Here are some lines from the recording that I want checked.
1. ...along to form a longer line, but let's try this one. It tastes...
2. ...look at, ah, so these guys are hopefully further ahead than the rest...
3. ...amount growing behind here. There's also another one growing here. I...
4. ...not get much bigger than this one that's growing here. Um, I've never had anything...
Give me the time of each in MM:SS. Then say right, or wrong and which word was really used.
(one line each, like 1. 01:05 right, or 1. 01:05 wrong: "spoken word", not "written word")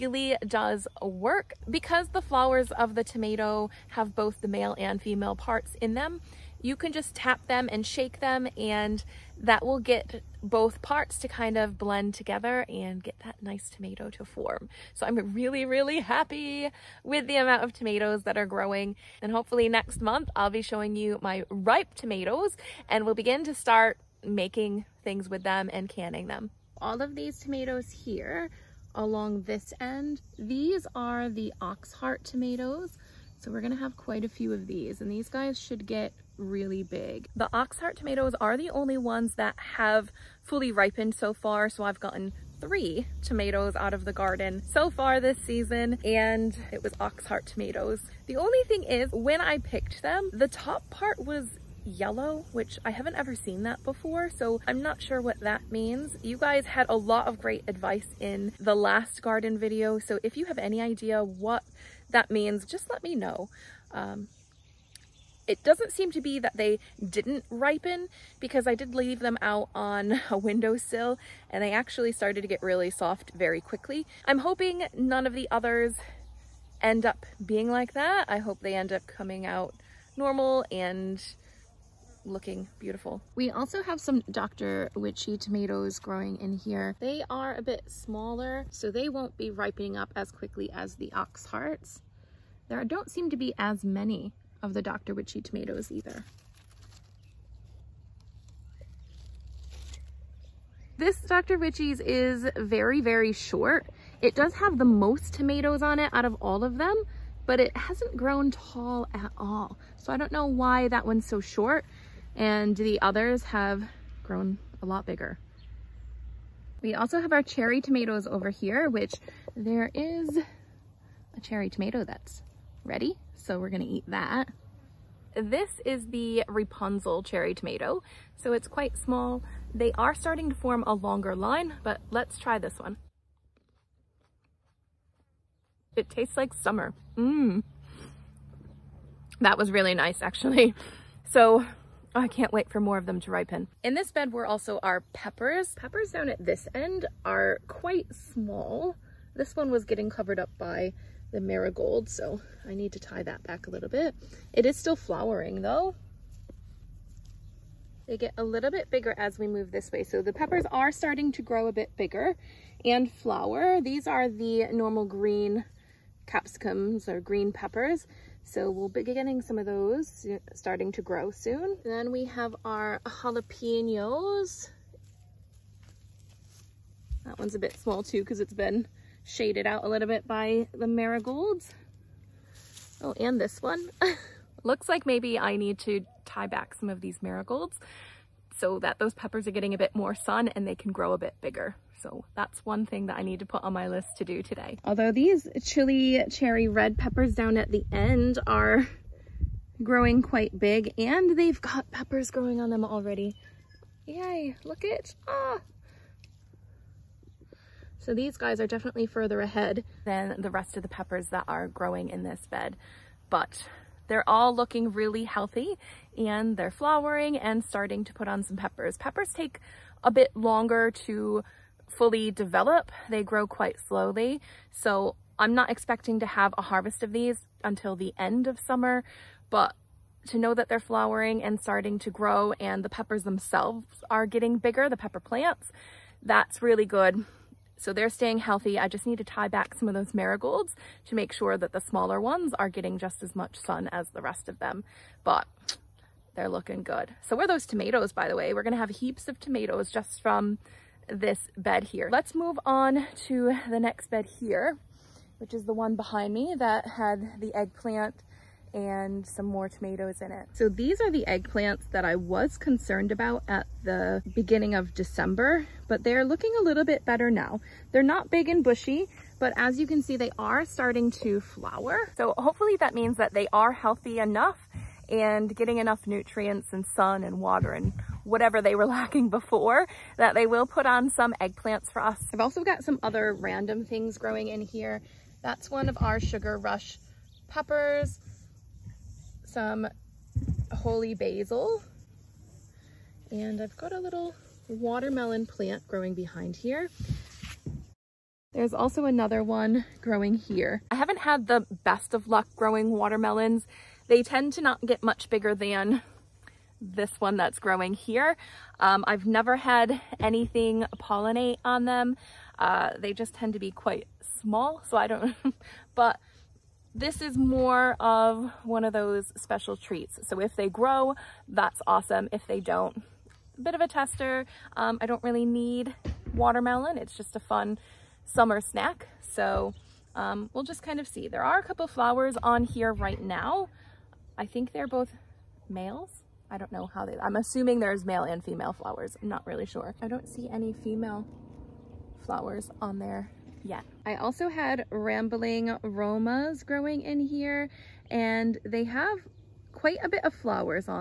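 1. 02:10 wrong: "starting", not "along"
2. 03:24 wrong: "definitely", not "hopefully"
3. 04:55 wrong: "plant", not "amount"
4. 05:04 right.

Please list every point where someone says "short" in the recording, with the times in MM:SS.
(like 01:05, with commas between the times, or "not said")
01:43, 01:51.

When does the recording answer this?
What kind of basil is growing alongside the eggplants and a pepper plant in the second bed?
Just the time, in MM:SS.
04:50.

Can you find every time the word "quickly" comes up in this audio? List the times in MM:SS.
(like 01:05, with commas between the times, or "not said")
01:13, 01:30.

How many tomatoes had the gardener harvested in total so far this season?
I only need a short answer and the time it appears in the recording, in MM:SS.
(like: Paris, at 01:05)
3, at 00:42.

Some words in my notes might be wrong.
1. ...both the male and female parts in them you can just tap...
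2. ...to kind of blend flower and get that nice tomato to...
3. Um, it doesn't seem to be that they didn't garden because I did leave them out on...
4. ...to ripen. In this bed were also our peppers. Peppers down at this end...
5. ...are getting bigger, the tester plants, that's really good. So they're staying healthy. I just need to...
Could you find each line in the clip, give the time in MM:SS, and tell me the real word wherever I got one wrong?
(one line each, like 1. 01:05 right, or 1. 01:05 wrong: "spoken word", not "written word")
1. 00:04 right
2. 00:11 wrong: "together", not "flower"
3. 01:03 wrong: "ripen", not "garden"
4. 02:23 right
5. 03:54 wrong: "pepper", not "tester".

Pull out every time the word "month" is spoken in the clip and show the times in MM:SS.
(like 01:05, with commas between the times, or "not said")
00:20.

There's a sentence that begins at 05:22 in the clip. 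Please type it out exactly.
If they don't, a bit of a tester.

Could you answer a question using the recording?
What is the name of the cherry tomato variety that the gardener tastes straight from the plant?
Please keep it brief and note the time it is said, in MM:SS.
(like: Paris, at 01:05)
Rapunzel, at 02:06.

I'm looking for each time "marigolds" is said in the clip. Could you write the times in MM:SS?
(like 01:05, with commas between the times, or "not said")
02:31, 03:00, 03:07, 04:00.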